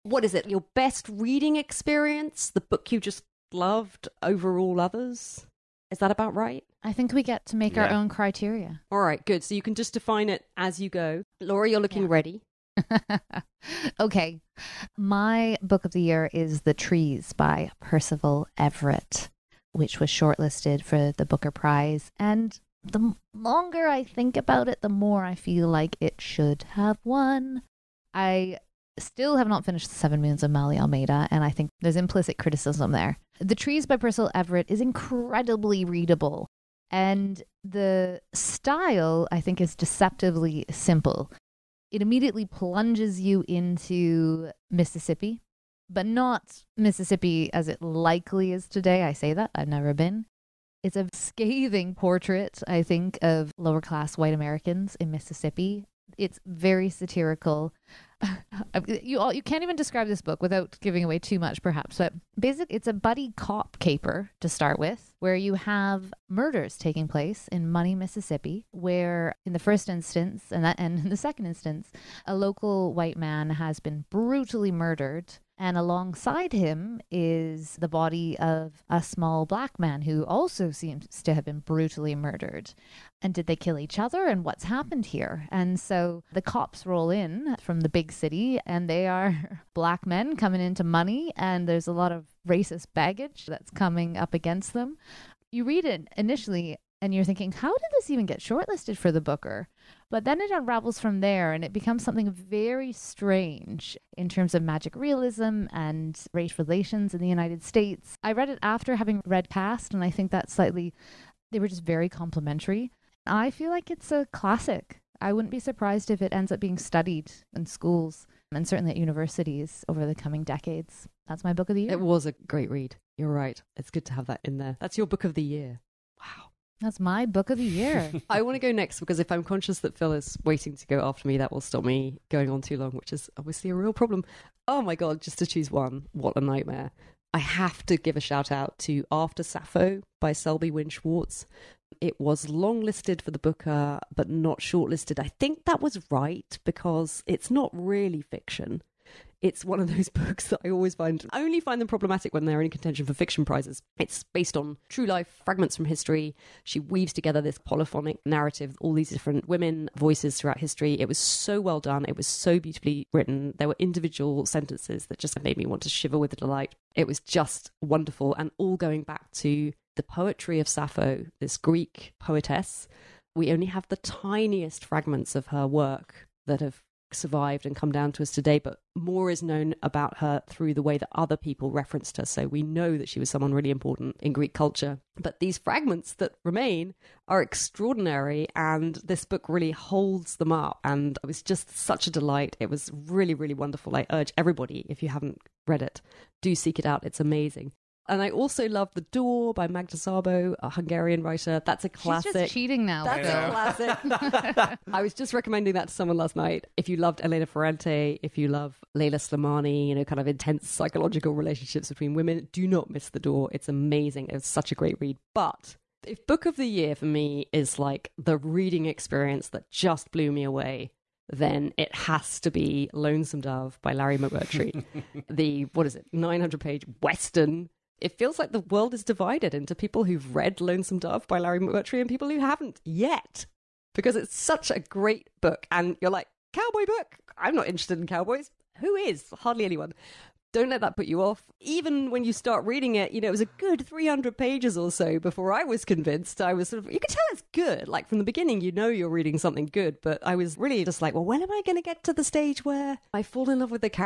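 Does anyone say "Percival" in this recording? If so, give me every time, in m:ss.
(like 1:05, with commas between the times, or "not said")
0:17, 0:33.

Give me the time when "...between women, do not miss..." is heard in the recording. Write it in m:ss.
3:31.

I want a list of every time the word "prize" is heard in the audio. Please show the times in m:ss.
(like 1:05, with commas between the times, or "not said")
0:21, 2:33.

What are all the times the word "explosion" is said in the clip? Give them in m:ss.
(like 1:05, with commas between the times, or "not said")
not said.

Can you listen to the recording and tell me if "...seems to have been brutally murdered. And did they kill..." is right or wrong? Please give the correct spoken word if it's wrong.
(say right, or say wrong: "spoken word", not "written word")
right.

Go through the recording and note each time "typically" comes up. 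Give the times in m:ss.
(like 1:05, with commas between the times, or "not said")
not said.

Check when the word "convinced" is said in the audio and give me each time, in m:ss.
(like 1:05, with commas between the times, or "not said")
4:05.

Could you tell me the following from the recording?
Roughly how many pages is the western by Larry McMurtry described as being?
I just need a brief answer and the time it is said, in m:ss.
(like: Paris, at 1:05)
900, at 3:46.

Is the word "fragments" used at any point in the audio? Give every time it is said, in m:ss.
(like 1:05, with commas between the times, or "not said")
2:35, 2:54, 3:05.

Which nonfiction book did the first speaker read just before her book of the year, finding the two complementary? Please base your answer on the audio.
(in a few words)
Caste.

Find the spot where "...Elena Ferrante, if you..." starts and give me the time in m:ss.
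3:27.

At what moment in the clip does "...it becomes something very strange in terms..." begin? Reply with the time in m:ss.
1:41.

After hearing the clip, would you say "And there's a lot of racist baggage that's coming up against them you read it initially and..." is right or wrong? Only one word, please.
right.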